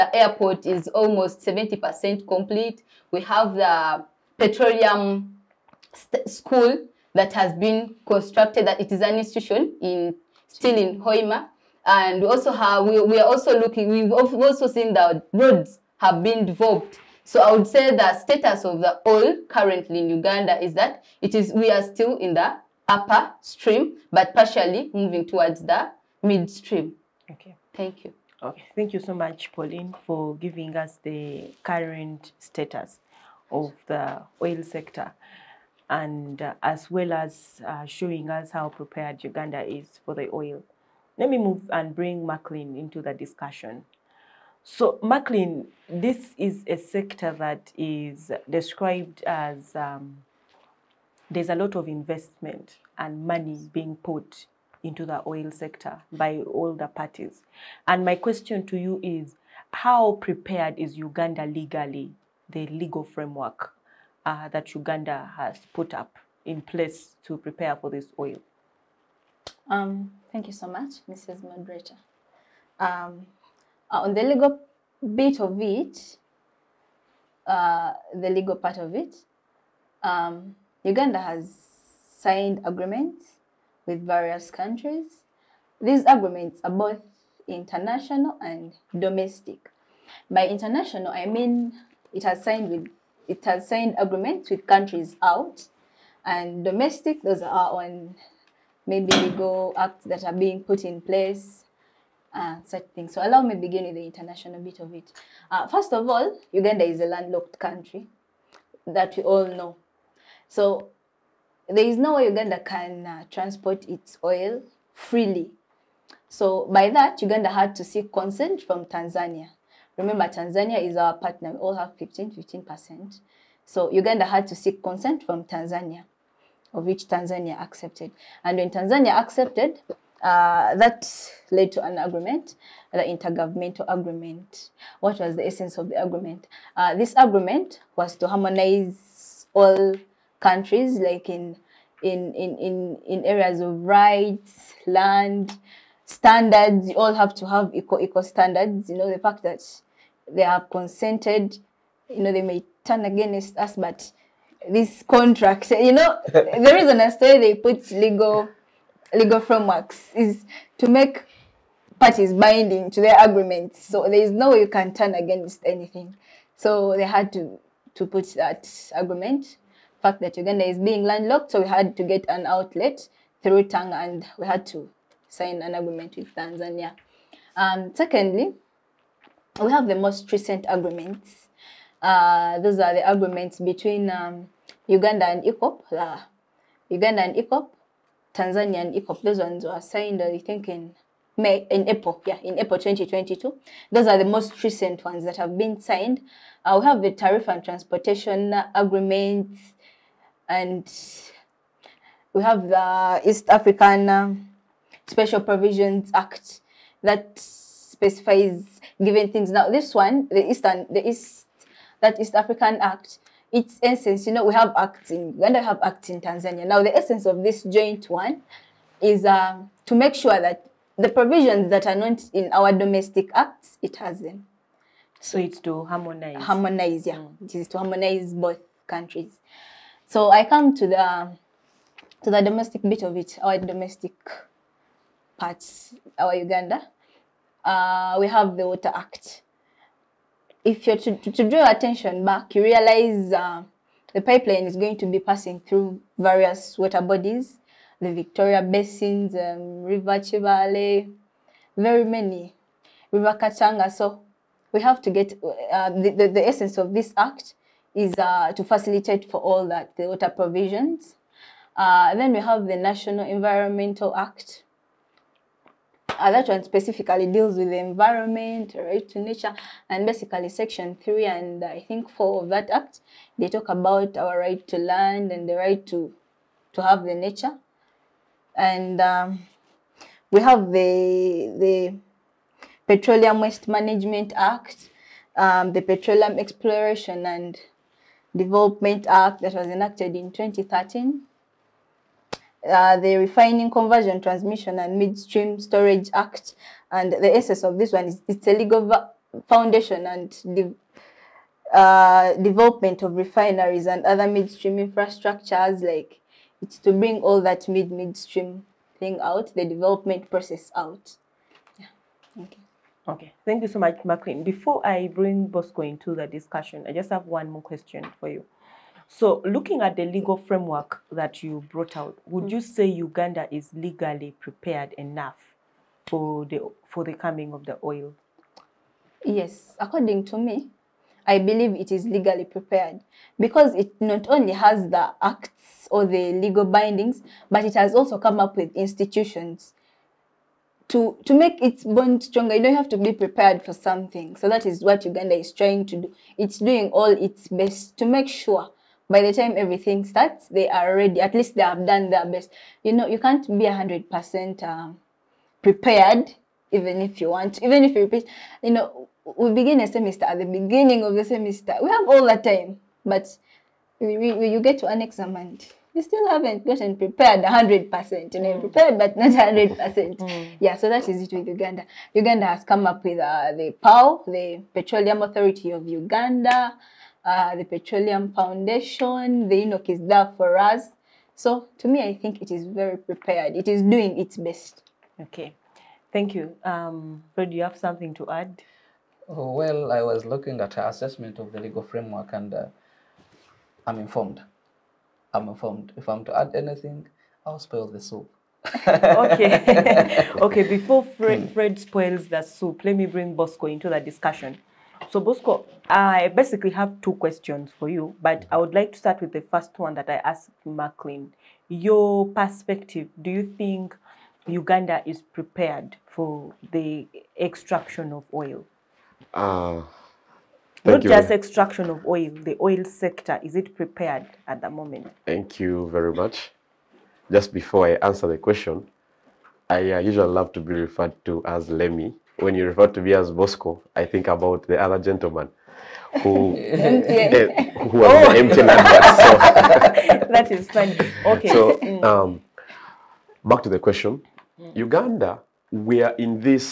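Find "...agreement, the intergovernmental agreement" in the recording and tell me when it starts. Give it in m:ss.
2:11.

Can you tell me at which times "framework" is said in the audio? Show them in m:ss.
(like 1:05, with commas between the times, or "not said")
1:03, 2:39, 5:20, 6:31.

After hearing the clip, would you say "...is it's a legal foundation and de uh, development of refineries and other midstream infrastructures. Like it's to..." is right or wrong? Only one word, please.
right.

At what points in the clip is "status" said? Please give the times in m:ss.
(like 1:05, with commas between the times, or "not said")
0:18, 0:32.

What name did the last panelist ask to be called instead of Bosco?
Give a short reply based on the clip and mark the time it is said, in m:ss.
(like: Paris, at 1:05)
Lemi, at 7:11.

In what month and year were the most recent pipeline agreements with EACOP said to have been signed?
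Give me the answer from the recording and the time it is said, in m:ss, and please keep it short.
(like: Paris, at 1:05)
April 2022, at 3:12.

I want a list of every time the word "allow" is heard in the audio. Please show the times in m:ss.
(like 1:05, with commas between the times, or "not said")
1:43.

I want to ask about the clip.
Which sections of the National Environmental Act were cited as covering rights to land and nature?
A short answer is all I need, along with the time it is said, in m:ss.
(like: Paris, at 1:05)
Section 3 and 4, at 4:30.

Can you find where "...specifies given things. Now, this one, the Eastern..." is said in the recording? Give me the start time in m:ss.
3:27.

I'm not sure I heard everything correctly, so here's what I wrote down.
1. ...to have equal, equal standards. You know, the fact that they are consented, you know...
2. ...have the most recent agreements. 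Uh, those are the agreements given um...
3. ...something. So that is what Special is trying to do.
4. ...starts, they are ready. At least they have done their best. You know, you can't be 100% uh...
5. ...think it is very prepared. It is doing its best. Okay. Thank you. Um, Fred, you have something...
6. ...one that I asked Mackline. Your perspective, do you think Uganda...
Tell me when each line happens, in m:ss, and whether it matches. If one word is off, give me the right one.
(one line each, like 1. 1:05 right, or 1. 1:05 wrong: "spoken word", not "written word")
1. 2:27 right
2. 2:59 wrong: "between", not "given"
3. 5:43 wrong: "Uganda", not "Special"
4. 5:50 right
5. 6:22 right
6. 6:49 right.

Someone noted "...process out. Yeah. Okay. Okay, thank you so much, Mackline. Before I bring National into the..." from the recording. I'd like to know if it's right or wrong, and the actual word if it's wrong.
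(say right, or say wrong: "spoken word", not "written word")
wrong: "Bosco", not "National".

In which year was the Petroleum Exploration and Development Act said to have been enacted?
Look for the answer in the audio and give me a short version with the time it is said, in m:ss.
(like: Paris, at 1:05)
2013, at 4:50.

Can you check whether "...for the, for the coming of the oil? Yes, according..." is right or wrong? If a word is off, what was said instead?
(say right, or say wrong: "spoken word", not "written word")
right.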